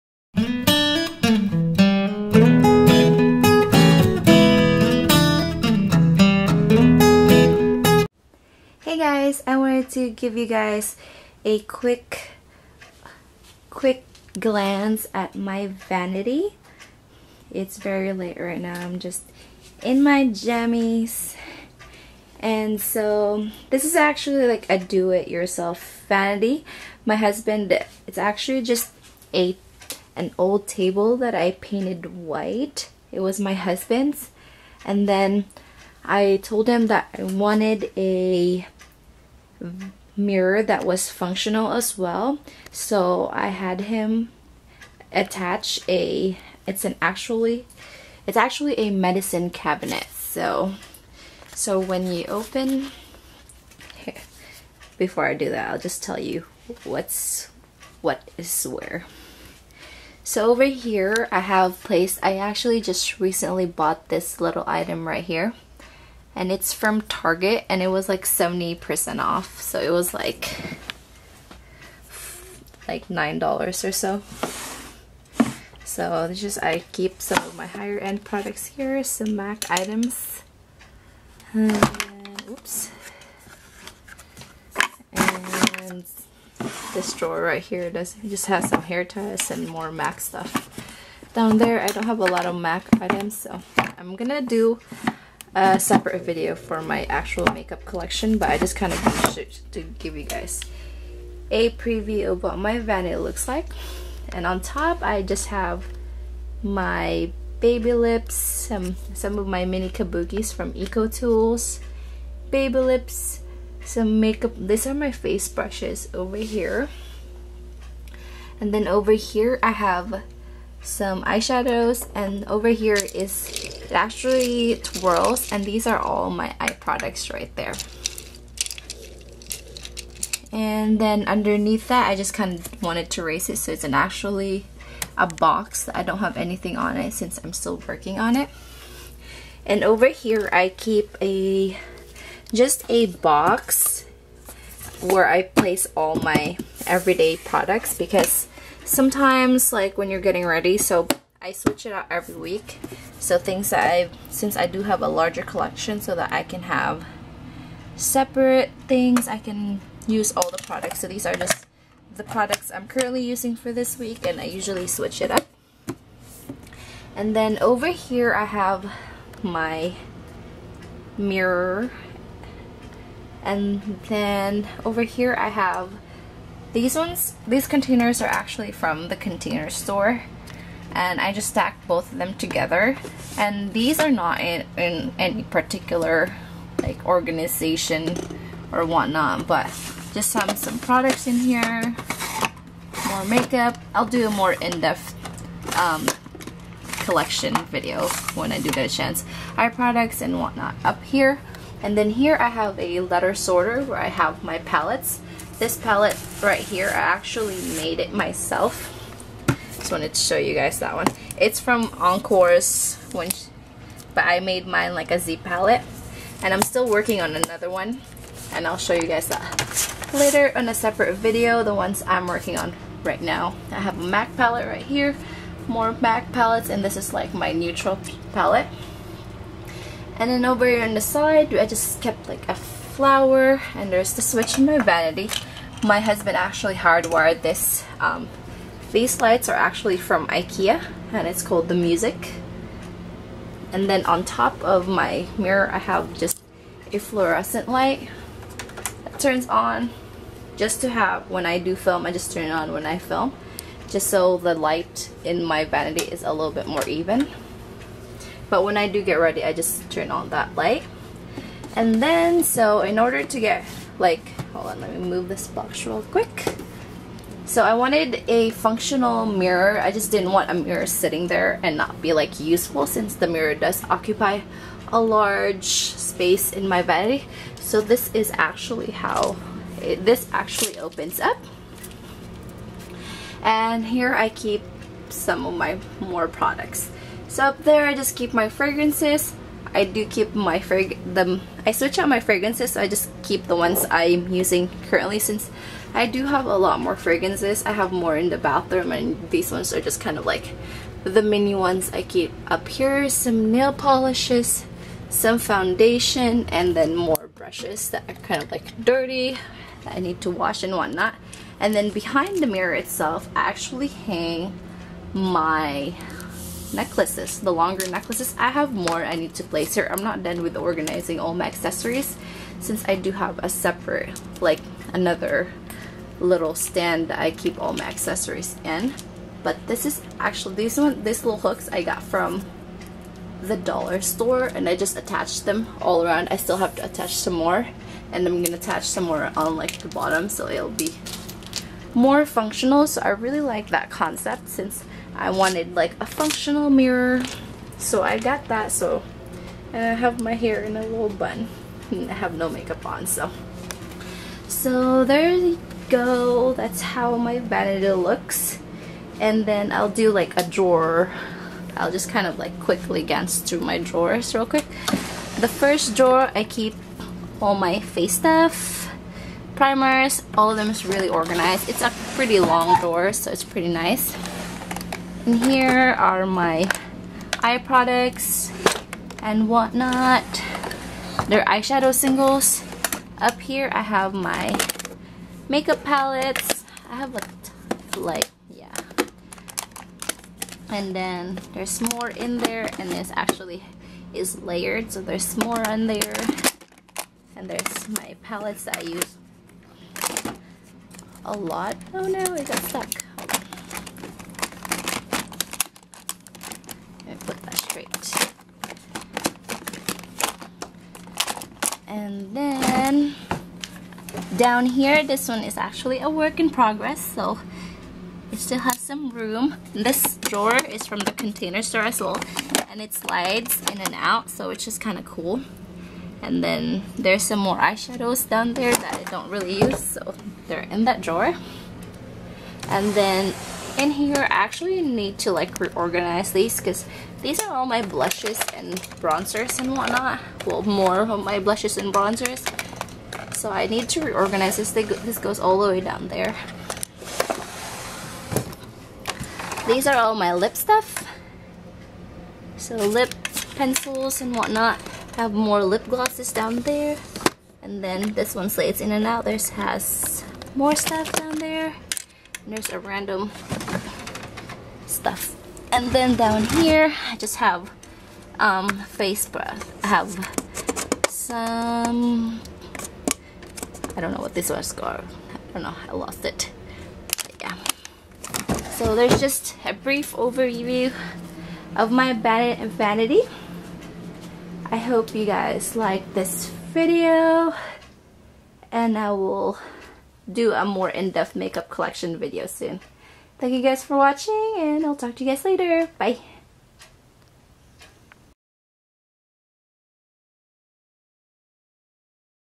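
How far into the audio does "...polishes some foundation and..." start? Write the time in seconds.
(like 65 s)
303 s.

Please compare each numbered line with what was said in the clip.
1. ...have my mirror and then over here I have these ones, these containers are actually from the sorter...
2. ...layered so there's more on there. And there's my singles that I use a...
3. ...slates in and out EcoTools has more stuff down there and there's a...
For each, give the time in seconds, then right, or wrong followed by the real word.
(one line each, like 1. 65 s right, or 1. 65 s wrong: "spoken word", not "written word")
1. 168 s wrong: "container", not "sorter"
2. 394 s wrong: "palettes", not "singles"
3. 458 s wrong: "This", not "EcoTools".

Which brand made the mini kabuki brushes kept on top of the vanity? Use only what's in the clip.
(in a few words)
EcoTools.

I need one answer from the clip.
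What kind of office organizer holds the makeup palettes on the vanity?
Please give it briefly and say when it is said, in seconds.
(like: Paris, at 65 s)
Letter sorter, at 203 s.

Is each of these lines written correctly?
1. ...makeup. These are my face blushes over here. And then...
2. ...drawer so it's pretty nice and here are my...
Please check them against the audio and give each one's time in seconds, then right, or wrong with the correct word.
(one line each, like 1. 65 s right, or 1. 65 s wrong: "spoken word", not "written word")
1. 114 s wrong: "brushes", not "blushes"
2. 372 s right.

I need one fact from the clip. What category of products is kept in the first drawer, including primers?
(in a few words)
Face stuff.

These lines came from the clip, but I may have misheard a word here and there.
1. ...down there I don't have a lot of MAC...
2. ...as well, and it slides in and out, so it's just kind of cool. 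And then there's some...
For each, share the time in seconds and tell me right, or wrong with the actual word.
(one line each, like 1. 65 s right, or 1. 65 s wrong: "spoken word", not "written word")
1. 91 s right
2. 421 s right.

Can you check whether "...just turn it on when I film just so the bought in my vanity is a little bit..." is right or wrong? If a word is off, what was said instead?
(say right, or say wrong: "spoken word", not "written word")
wrong: "light", not "bought".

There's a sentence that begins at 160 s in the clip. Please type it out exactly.
So these are just the products I'm currently using for this week and I usually switch it up.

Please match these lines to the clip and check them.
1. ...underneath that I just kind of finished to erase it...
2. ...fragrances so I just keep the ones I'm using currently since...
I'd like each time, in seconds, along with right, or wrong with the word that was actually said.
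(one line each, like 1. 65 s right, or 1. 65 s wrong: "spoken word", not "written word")
1. 131 s wrong: "wanted", not "finished"
2. 292 s right.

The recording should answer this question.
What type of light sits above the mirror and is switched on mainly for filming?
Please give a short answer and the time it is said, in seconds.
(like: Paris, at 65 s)
Fluorescent light, at 246 s.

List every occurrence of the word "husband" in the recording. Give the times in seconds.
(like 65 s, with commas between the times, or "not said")
27 s, 33 s, 235 s.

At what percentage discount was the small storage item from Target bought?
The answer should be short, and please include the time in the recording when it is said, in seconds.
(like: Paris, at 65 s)
70%, at 68 s.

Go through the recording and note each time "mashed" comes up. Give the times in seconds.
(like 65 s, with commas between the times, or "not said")
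not said.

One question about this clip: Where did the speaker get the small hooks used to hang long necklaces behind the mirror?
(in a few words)
The dollar store.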